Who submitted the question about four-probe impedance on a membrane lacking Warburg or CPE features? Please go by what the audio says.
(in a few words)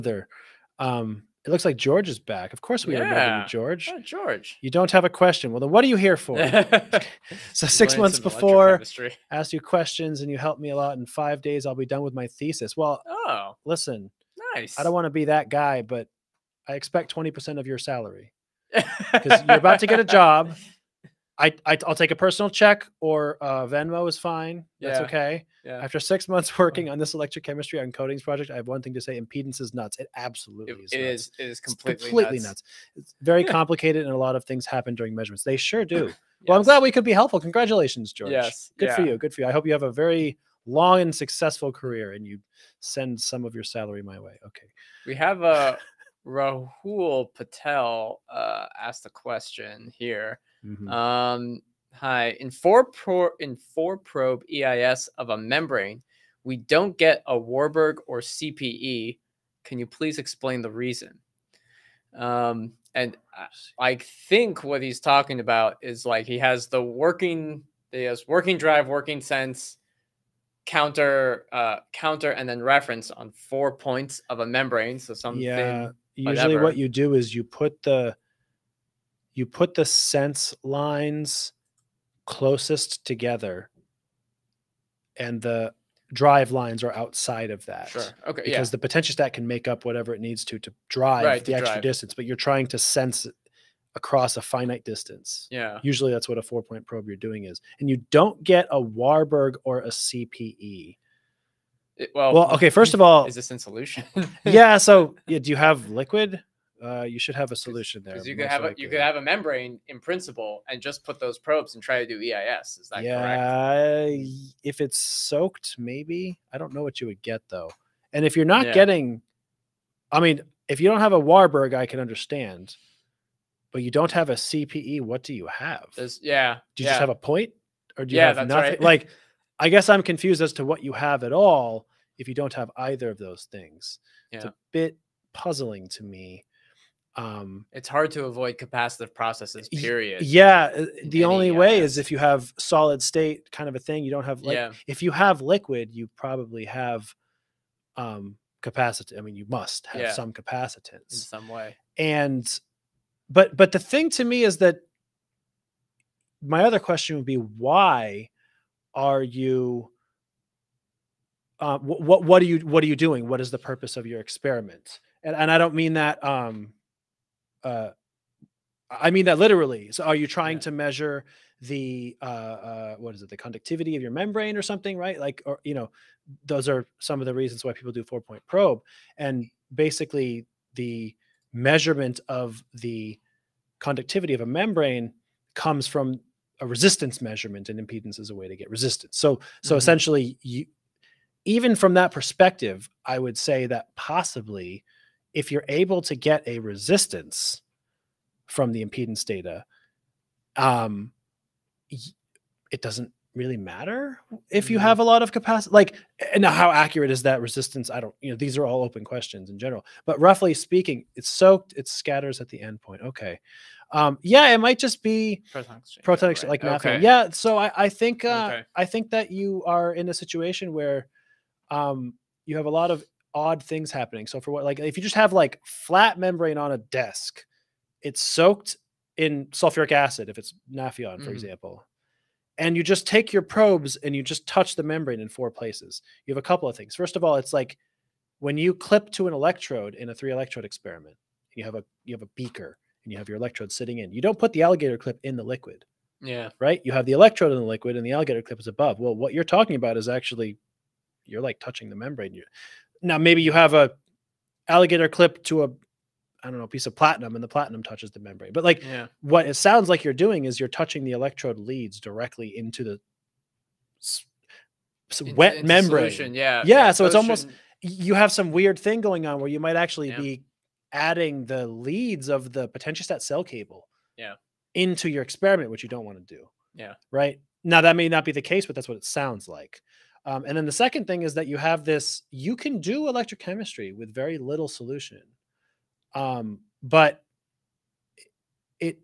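Rahul Patel.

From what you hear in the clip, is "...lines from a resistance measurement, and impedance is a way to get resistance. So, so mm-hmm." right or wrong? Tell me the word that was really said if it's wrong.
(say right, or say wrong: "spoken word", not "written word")
wrong: "comes", not "lines".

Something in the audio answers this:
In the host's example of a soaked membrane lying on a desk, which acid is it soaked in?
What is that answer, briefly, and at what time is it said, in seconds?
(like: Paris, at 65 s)
sulfuric acid, at 229 s.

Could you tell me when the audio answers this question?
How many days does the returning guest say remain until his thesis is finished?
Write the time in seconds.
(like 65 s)
11 s.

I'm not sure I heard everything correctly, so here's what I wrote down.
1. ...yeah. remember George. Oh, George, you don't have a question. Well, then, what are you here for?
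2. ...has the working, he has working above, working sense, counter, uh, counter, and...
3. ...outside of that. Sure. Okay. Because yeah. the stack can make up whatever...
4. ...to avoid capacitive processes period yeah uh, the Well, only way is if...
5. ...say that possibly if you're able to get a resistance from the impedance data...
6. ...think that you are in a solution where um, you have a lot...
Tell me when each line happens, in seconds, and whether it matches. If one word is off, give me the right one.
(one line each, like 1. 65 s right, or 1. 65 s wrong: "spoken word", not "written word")
1. 2 s right
2. 66 s wrong: "drive", not "above"
3. 86 s right
4. 138 s wrong: "Any", not "Well"
5. 193 s right
6. 218 s wrong: "situation", not "solution".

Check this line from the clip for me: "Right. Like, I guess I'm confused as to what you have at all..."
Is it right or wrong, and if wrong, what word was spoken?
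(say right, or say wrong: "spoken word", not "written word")
right.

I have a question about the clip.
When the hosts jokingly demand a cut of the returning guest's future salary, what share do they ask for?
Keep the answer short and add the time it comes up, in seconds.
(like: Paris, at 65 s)
20 percent, at 17 s.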